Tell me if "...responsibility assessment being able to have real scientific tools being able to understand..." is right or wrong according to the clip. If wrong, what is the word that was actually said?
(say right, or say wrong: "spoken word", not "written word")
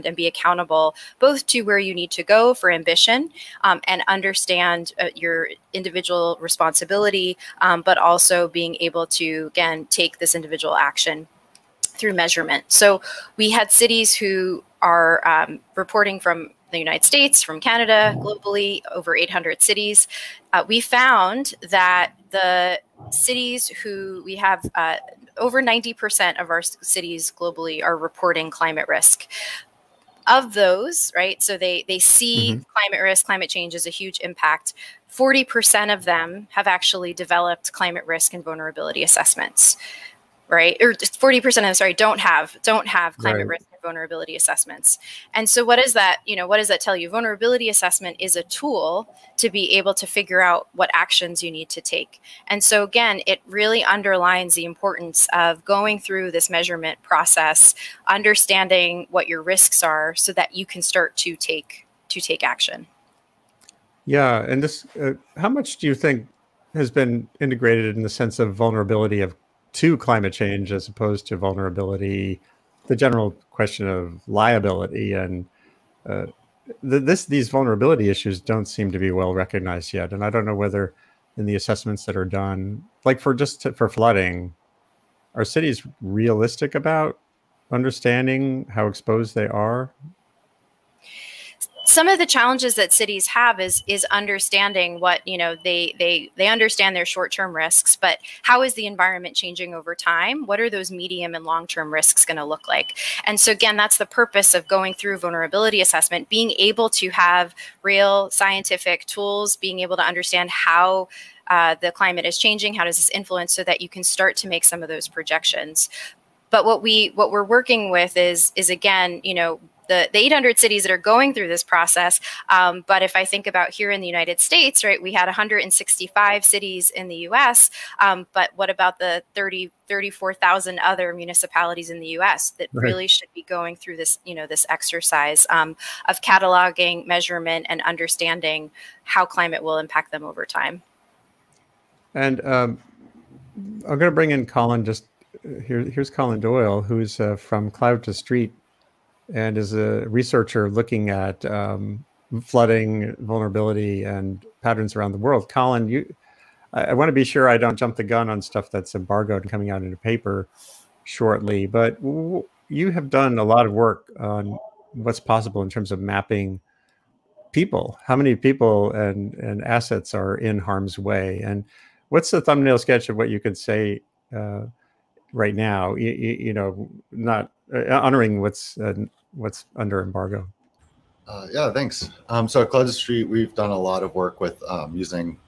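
wrong: "vulnerability", not "responsibility".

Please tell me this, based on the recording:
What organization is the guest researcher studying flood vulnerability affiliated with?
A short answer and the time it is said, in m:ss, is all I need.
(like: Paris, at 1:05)
Cloud to Street, at 2:27.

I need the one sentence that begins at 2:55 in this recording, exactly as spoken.
You, you, you know, not uh, honoring what's uh, what's under embargo?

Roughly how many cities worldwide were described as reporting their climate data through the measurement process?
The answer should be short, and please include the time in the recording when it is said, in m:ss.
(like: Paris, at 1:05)
over 800, at 0:18.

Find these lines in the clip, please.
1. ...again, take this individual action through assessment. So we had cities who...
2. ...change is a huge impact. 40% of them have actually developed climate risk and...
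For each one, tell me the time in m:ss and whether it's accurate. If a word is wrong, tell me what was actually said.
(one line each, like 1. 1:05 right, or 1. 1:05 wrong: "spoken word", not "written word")
1. 0:09 wrong: "measurement", not "assessment"
2. 0:33 right.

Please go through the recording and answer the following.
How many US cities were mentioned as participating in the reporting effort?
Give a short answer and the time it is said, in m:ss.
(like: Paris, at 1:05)
165, at 2:05.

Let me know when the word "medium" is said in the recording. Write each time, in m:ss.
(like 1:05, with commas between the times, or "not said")
1:40.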